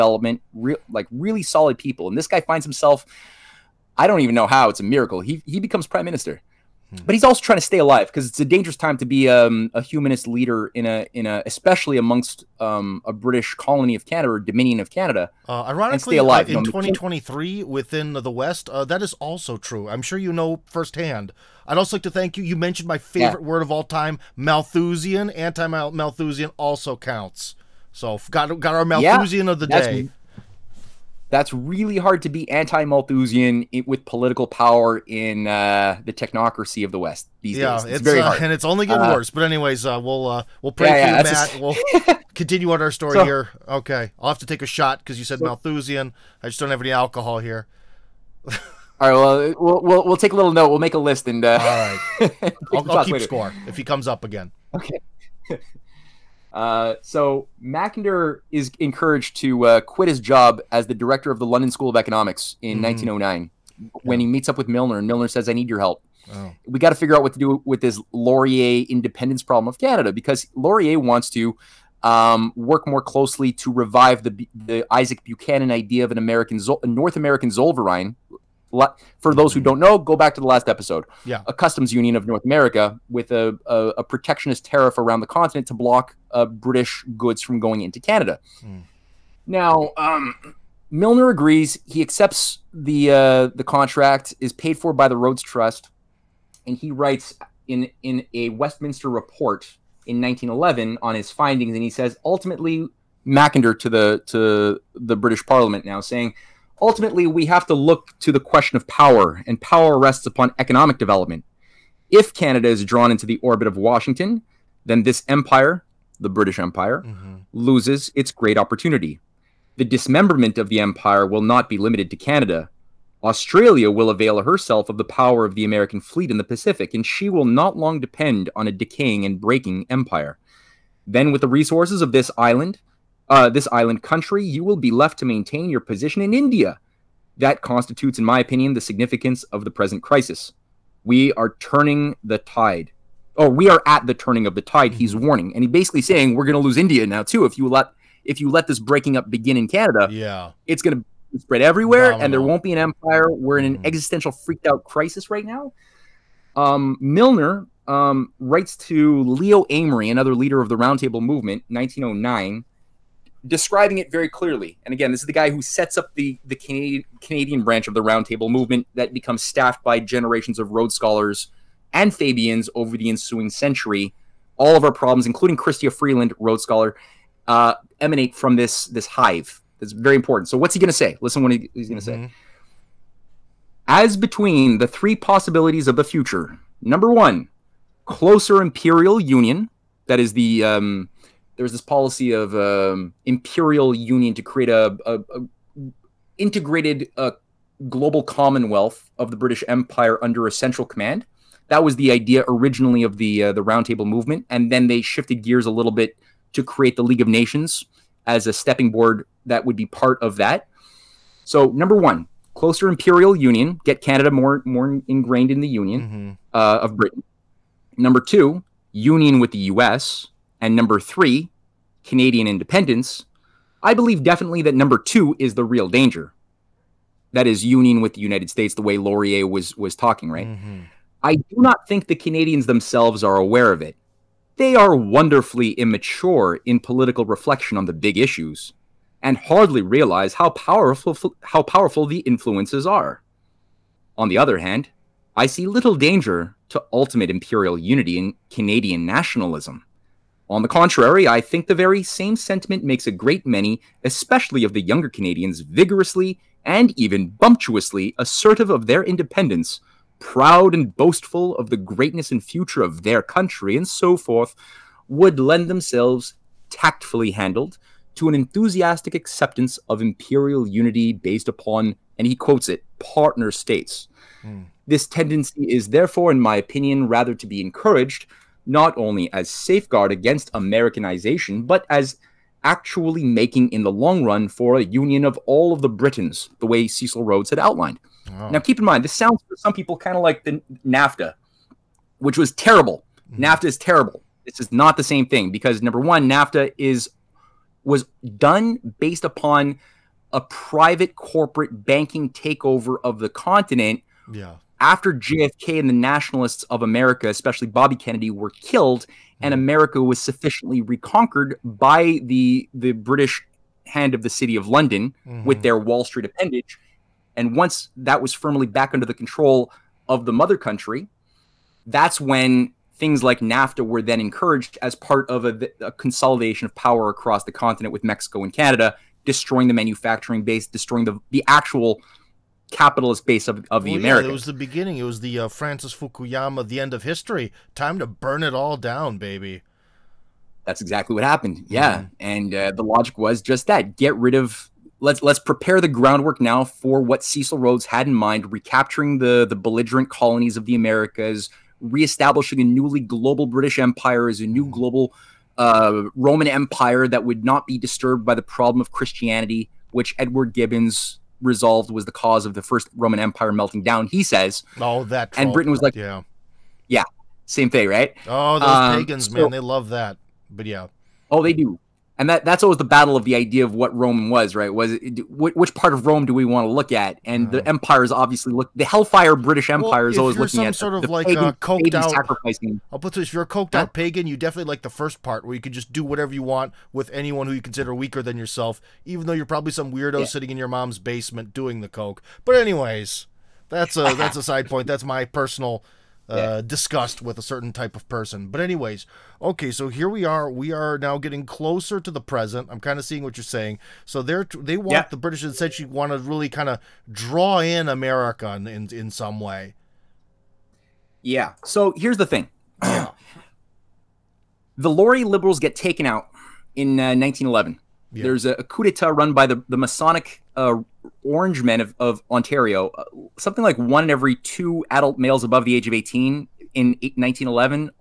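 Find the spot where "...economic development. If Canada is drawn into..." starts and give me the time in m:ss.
1:50.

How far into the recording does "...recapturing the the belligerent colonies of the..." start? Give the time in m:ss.
5:48.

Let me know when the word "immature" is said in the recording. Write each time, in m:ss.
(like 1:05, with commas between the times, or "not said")
3:55.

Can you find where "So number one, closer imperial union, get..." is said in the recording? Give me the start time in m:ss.
3:31.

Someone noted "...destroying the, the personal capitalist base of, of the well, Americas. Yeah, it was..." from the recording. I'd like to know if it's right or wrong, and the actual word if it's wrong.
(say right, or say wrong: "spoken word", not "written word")
wrong: "actual", not "personal".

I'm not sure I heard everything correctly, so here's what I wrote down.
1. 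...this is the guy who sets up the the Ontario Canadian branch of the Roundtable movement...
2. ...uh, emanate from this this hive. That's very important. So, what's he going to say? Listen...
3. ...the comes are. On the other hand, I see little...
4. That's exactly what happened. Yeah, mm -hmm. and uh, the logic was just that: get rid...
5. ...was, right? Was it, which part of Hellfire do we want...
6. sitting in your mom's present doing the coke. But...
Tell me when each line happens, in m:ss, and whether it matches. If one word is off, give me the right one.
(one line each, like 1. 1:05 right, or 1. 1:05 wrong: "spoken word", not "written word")
1. 2:45 wrong: "Canadian", not "Ontario"
2. 2:57 right
3. 4:02 wrong: "influences", not "comes"
4. 5:40 right
5. 6:14 wrong: "Rome", not "Hellfire"
6. 6:30 wrong: "basement", not "present".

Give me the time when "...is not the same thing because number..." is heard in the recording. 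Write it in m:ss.
4:54.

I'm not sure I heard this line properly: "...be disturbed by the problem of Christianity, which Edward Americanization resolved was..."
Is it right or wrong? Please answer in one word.
wrong.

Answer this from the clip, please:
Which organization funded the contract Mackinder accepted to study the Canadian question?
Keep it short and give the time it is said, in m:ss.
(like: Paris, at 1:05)
Rhodes Trust, at 1:35.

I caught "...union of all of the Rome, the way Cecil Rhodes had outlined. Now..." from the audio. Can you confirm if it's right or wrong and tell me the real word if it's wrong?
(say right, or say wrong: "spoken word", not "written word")
wrong: "Britons", not "Rome".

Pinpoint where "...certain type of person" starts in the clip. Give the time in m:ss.
6:37.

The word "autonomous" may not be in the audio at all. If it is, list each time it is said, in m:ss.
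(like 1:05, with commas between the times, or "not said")
not said.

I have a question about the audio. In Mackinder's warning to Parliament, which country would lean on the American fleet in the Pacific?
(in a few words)
Australia.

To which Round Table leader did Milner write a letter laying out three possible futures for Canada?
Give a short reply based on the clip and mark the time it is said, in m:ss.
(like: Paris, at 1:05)
Leo Amery, at 2:39.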